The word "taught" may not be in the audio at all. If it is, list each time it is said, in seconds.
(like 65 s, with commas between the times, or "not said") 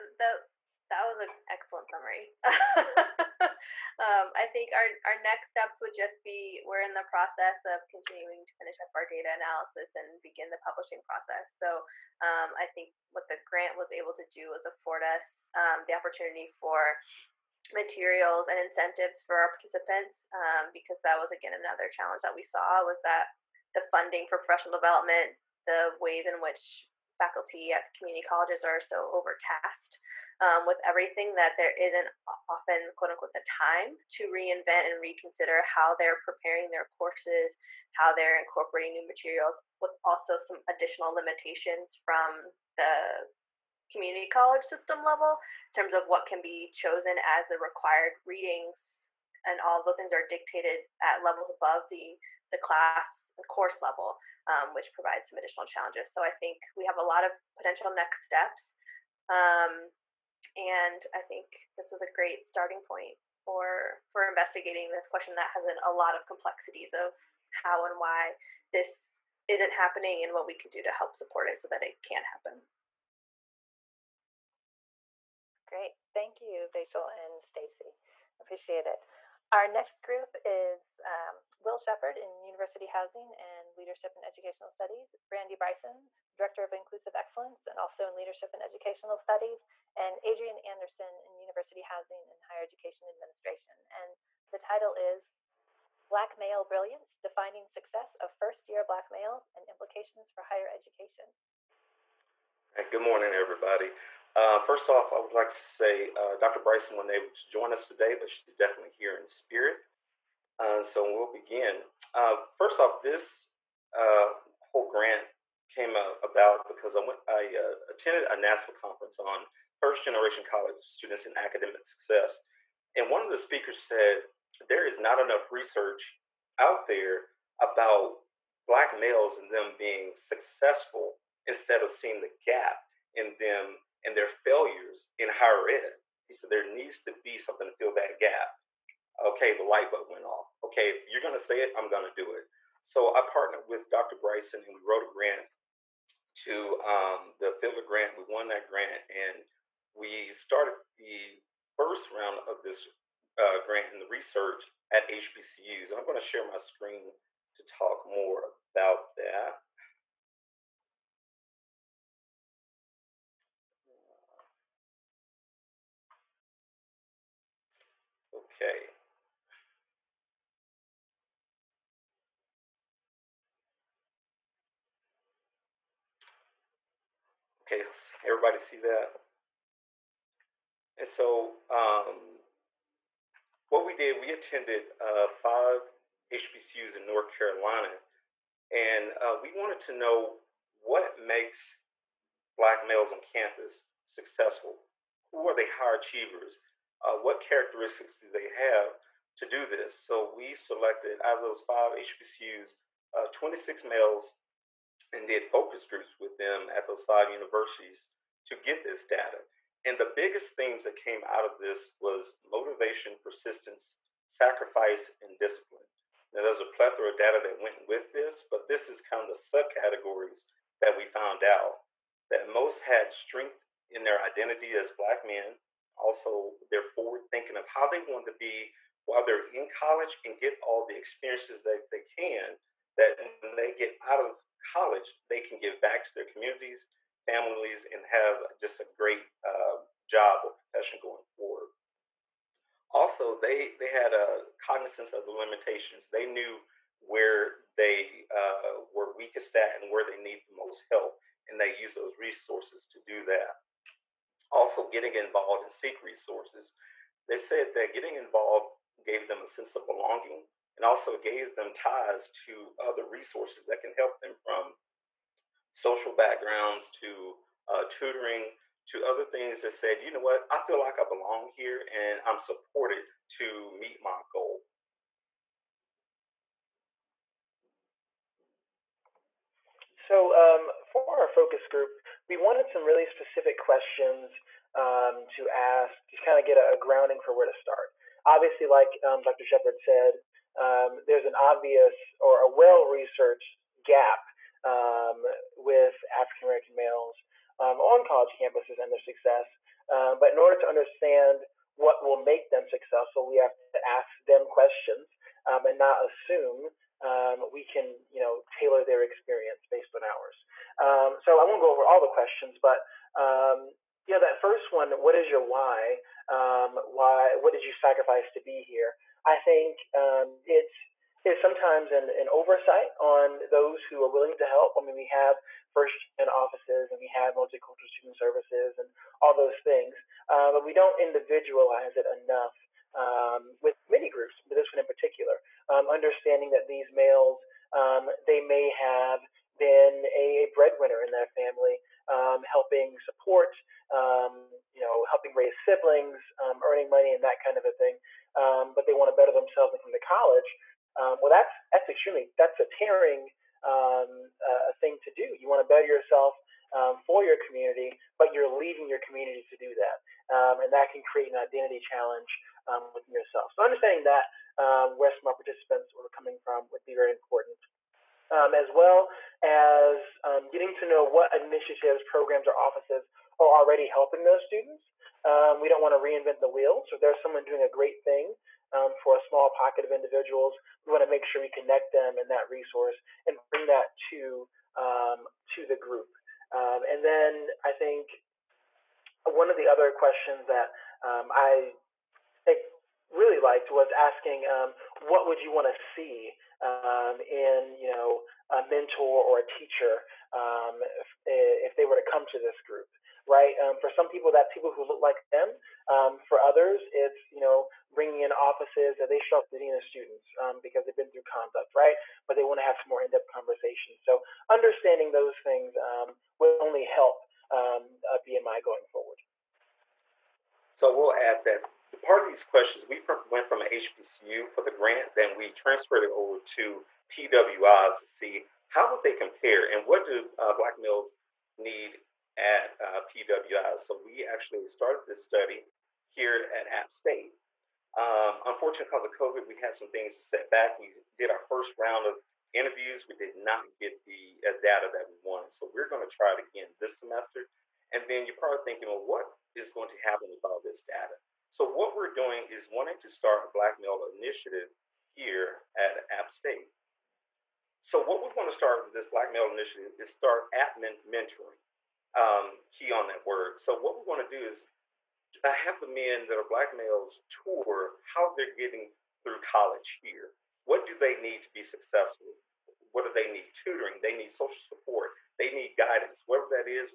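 not said.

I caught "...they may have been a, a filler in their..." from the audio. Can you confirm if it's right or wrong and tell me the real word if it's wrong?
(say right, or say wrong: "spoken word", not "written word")
wrong: "breadwinner", not "filler".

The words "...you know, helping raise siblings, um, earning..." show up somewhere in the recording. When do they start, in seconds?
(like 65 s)
344 s.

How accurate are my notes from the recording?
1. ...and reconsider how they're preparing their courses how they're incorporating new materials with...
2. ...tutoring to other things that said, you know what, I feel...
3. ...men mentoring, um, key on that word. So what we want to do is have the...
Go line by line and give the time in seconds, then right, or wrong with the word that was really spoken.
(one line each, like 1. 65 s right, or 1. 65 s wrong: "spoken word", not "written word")
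1. 34 s right
2. 267 s right
3. 460 s right.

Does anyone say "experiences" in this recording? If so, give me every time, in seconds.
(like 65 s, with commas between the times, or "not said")
230 s, 309 s.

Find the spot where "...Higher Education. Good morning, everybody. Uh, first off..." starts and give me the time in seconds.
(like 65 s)
100 s.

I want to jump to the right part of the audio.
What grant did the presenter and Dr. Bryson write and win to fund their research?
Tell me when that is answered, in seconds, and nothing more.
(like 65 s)
147 s.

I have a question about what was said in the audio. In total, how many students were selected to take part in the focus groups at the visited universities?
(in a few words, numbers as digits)
26.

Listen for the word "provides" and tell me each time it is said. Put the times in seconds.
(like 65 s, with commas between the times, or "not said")
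54 s.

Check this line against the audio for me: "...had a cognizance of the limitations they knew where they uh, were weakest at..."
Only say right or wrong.
right.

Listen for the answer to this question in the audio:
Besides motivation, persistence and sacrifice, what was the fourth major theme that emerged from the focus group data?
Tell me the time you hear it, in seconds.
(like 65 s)
215 s.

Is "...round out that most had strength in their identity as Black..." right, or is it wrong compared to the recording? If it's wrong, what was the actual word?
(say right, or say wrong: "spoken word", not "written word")
wrong: "found", not "round".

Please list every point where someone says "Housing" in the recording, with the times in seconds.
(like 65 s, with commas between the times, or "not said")
82 s, 91 s.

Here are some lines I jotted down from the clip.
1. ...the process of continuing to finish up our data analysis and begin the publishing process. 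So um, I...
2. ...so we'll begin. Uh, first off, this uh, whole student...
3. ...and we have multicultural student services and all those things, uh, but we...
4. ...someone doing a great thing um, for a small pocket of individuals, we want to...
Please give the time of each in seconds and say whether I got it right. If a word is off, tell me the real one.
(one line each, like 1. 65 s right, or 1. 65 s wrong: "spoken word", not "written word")
1. 6 s right
2. 110 s wrong: "grant", not "student"
3. 326 s right
4. 377 s right.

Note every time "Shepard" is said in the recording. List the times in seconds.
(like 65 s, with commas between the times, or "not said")
81 s, 289 s.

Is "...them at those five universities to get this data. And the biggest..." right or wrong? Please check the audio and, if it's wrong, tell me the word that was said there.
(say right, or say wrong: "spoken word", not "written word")
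right.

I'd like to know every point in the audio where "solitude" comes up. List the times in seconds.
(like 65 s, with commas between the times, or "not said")
not said.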